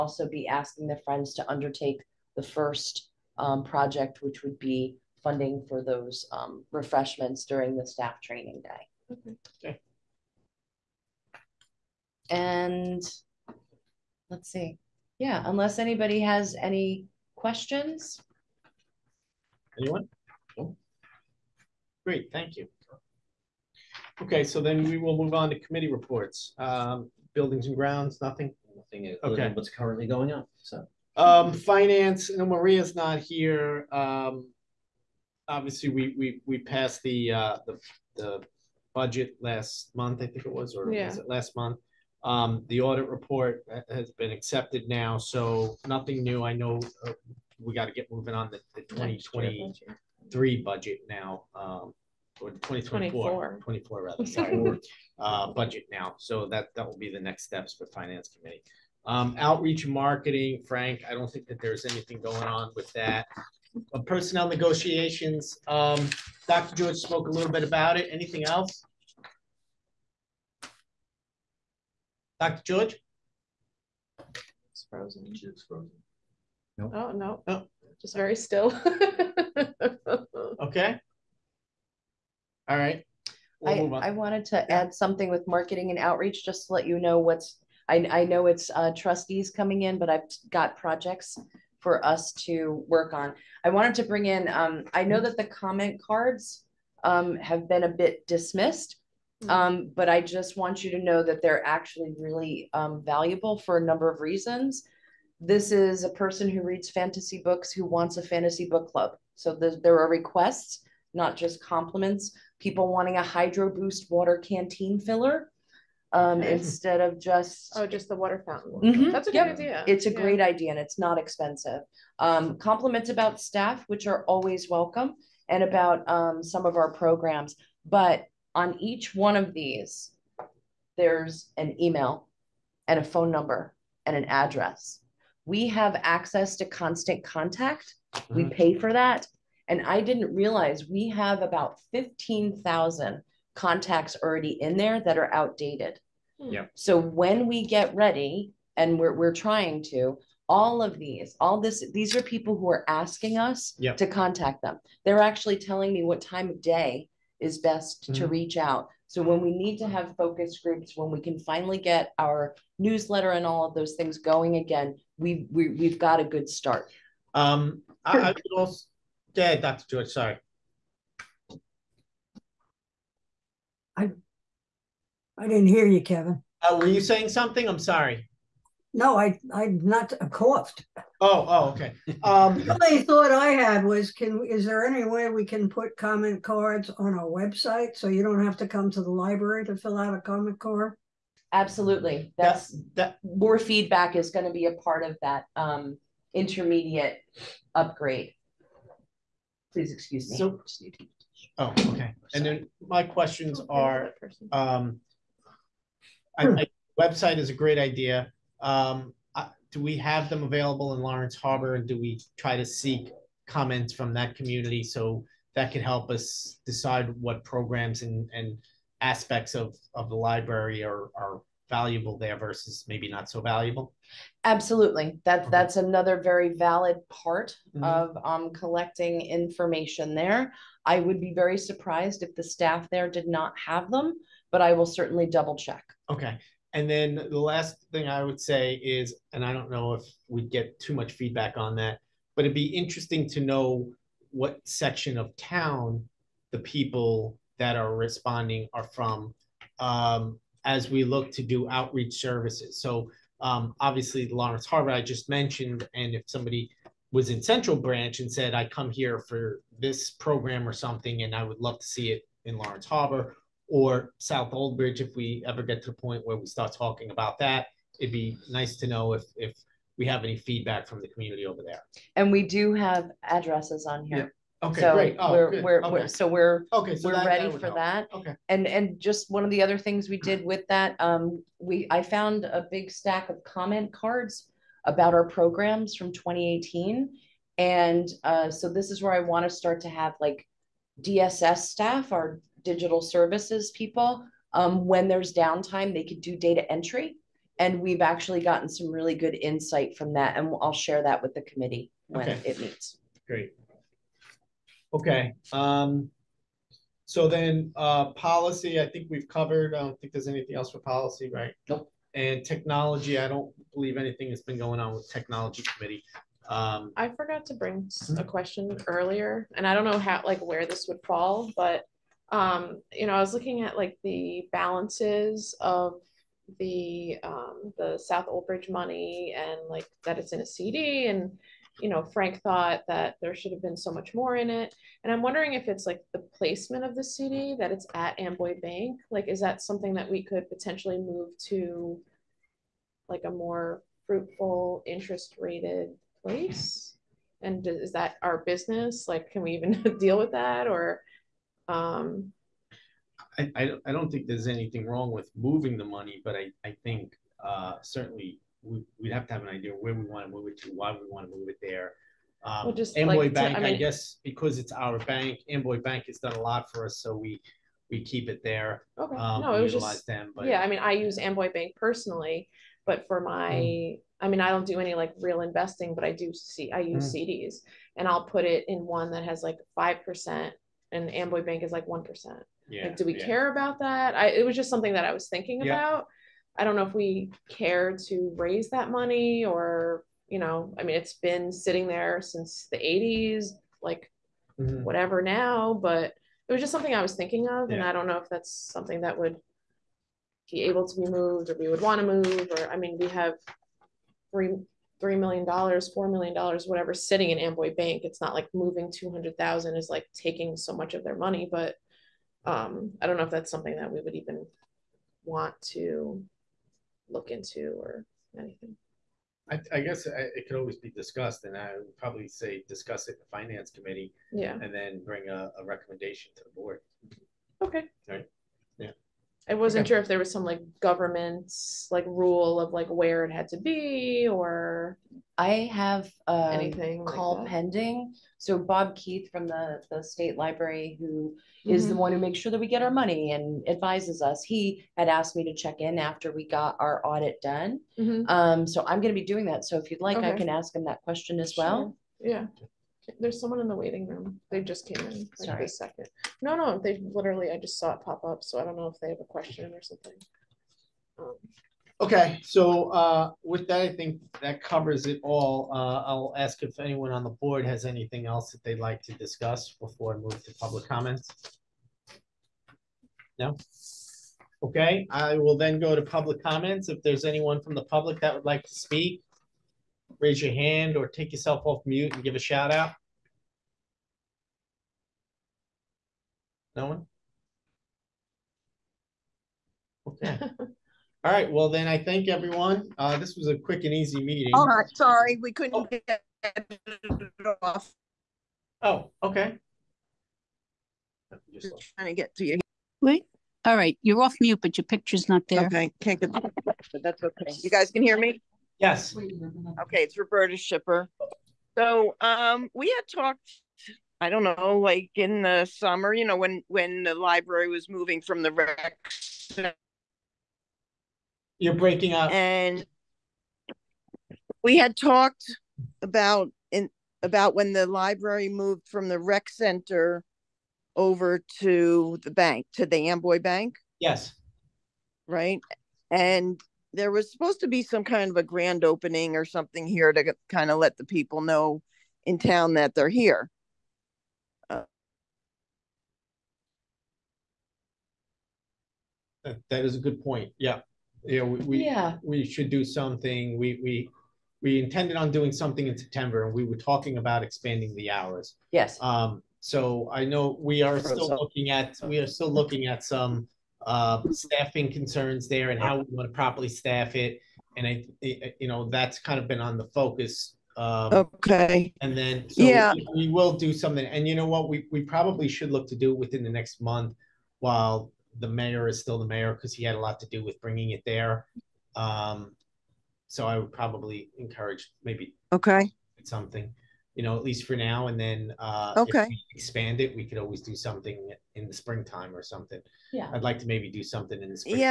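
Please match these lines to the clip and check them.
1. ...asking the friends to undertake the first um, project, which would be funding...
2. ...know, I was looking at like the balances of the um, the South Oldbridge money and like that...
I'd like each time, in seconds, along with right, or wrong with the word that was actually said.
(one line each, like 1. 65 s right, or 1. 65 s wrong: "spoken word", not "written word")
1. 0 s right
2. 323 s right.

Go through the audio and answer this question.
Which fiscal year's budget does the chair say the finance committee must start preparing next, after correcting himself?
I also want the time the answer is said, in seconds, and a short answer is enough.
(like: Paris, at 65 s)
2024, at 52 s.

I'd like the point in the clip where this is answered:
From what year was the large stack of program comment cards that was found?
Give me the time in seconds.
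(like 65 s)
286 s.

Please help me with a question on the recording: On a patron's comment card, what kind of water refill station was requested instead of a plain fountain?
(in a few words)
hydro boost water canteen filler.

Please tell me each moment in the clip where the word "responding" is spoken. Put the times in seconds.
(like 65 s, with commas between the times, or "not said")
247 s.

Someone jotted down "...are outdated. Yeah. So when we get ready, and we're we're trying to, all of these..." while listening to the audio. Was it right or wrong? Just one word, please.
right.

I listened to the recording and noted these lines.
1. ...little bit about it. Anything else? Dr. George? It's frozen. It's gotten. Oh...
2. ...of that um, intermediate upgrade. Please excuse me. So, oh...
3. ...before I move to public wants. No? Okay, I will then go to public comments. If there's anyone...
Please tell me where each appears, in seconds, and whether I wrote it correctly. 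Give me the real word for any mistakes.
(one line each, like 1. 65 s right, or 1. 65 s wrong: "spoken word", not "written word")
1. 67 s wrong: "frozen", not "gotten"
2. 195 s right
3. 469 s wrong: "comments", not "wants".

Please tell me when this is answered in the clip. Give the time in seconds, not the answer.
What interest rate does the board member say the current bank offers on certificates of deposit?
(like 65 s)
381 s.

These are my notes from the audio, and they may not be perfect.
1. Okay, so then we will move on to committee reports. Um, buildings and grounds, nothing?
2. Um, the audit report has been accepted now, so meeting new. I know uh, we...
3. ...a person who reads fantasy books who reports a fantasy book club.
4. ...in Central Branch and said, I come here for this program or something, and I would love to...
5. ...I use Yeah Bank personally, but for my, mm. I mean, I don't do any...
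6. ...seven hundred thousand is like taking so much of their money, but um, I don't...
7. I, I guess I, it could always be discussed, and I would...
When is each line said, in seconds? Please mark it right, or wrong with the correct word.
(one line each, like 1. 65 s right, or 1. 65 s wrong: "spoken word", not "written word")
1. 24 s right
2. 42 s wrong: "nothing", not "meeting"
3. 106 s wrong: "wants", not "reports"
4. 257 s right
5. 370 s wrong: "Amboy", not "Yeah"
6. 408 s wrong: "two", not "seven"
7. 419 s right.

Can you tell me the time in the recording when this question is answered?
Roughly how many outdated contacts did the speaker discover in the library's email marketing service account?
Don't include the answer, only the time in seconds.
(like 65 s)
141 s.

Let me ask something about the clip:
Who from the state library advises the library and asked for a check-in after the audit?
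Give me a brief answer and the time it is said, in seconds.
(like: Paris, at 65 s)
Bob Keith, at 438 s.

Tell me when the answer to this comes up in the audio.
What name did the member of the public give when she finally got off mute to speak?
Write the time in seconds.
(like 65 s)
510 s.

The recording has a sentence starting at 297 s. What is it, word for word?
And we've actually gotten some really good insight from that.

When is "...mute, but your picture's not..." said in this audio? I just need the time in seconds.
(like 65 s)
504 s.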